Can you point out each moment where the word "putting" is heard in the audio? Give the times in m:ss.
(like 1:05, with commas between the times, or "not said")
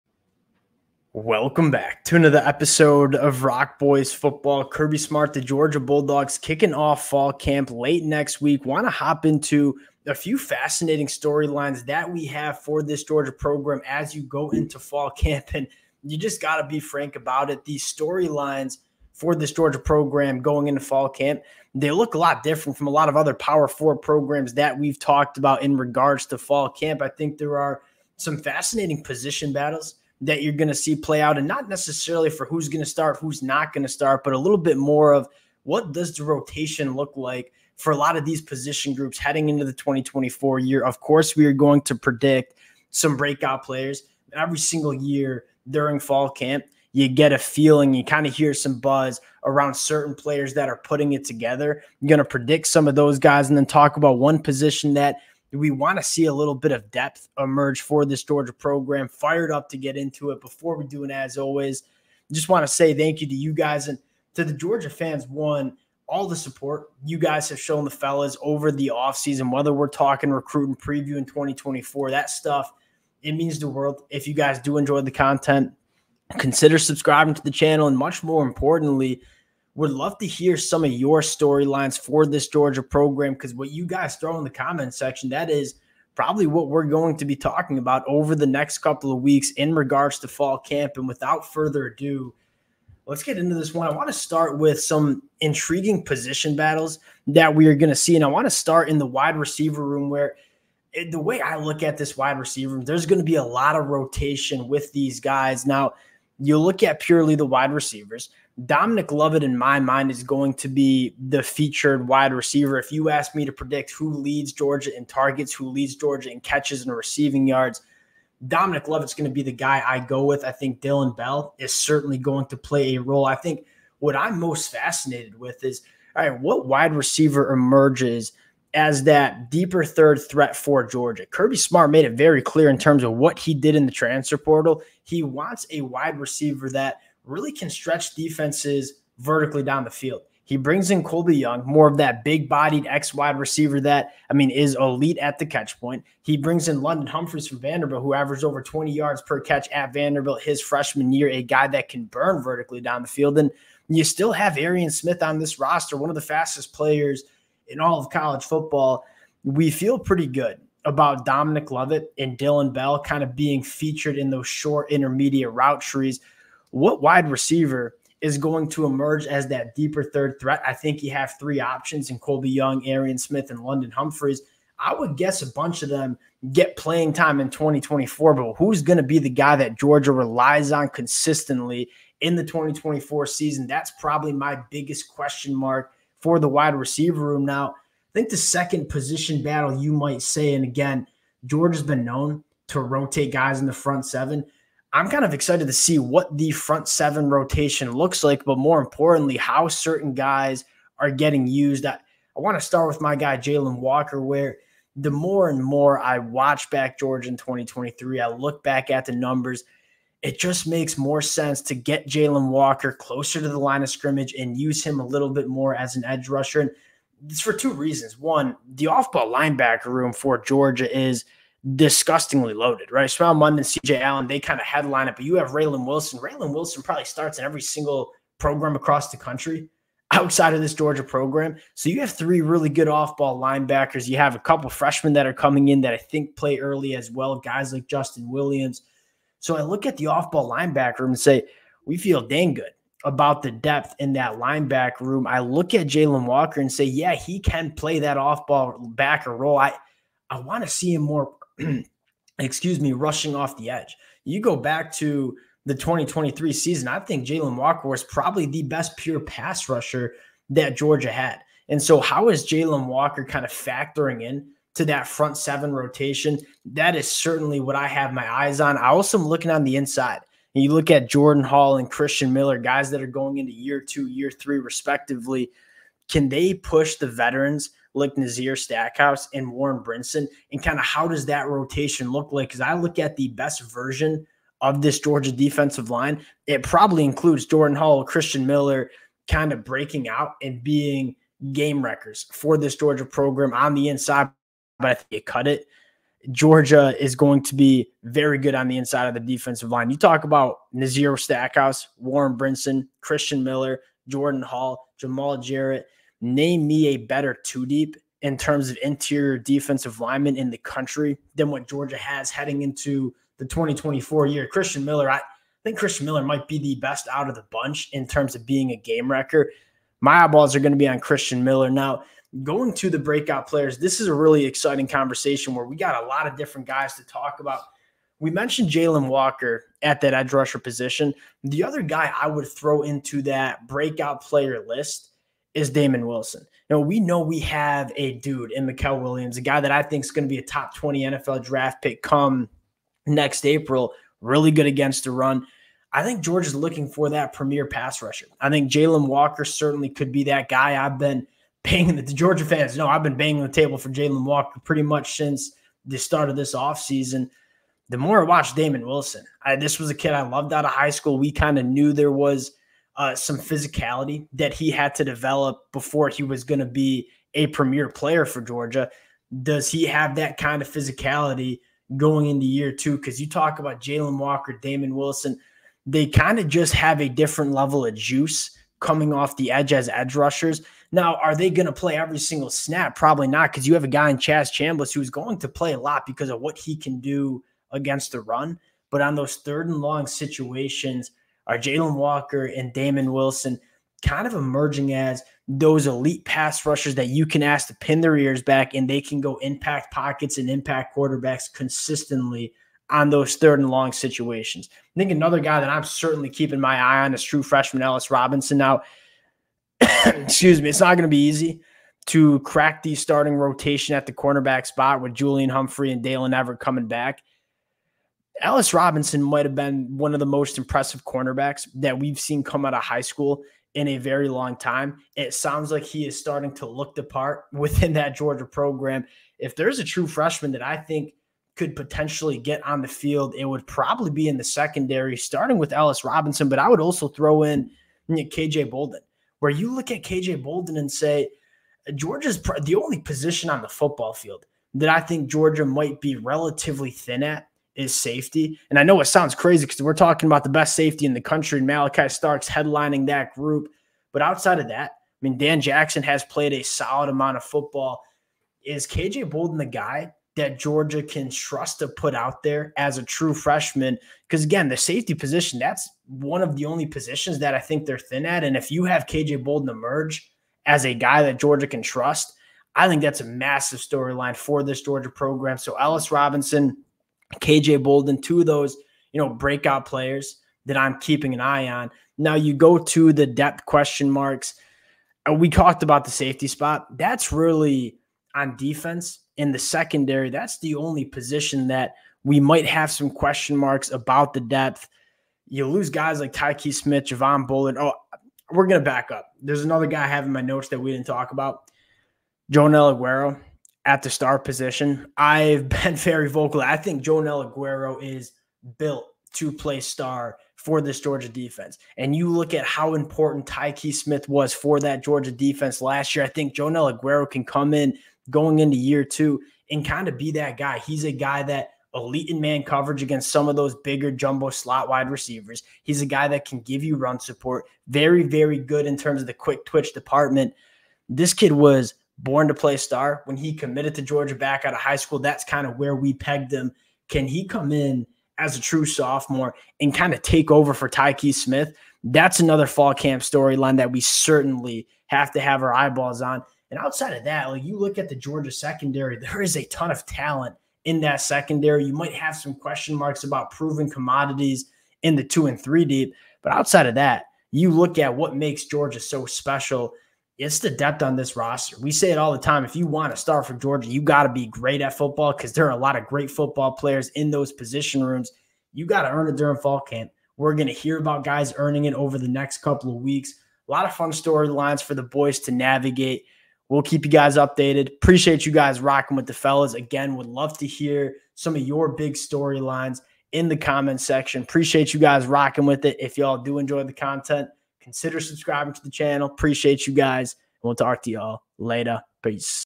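0:50.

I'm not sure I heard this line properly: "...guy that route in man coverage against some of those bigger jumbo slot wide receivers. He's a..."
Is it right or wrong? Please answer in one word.
wrong.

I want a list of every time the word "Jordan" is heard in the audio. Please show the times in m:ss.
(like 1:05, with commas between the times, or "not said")
4:31, 4:47, 5:04.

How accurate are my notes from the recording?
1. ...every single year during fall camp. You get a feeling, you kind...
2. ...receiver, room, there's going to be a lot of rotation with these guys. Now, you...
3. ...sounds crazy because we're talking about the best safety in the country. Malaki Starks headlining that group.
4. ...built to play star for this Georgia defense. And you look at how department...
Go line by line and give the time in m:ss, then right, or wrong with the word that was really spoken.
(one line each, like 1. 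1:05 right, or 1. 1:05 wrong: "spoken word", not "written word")
1. 0:44 right
2. 1:42 right
3. 7:29 right
4. 8:28 wrong: "important", not "department".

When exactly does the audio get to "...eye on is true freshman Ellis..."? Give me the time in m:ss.
6:46.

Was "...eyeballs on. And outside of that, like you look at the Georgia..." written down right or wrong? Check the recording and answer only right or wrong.
right.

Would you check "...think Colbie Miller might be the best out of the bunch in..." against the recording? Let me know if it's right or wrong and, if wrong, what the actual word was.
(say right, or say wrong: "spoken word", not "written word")
wrong: "Christian", not "Colbie".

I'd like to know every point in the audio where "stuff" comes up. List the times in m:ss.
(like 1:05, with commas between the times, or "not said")
1:12.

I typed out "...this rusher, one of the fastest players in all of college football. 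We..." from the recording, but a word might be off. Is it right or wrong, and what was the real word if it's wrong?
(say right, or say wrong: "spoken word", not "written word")
wrong: "roster", not "rusher".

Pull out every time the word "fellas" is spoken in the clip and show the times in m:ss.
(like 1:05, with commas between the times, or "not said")
1:07, 9:39.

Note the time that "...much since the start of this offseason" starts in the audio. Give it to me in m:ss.
5:54.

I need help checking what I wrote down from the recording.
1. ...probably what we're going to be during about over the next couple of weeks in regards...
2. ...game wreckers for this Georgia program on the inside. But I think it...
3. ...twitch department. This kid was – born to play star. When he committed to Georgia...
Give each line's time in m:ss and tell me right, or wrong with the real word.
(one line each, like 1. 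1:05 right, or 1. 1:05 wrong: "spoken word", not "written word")
1. 1:26 wrong: "talking", not "during"
2. 4:51 right
3. 8:49 right.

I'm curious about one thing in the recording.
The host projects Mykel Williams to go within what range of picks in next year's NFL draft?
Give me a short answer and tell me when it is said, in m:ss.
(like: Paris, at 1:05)
Top 20, at 5:40.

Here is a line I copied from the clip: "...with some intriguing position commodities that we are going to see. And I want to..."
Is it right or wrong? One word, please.
wrong.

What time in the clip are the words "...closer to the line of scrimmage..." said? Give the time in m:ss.
3:32.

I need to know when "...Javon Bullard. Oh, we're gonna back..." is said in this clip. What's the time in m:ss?
8:17.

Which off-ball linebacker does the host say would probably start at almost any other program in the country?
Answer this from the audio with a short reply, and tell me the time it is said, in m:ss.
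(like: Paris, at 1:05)
Raylen Wilson, at 3:46.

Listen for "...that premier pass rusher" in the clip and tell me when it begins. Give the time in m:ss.
5:47.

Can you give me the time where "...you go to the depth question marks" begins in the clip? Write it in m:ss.
8:02.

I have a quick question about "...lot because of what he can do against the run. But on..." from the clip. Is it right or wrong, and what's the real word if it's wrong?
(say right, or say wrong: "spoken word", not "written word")
right.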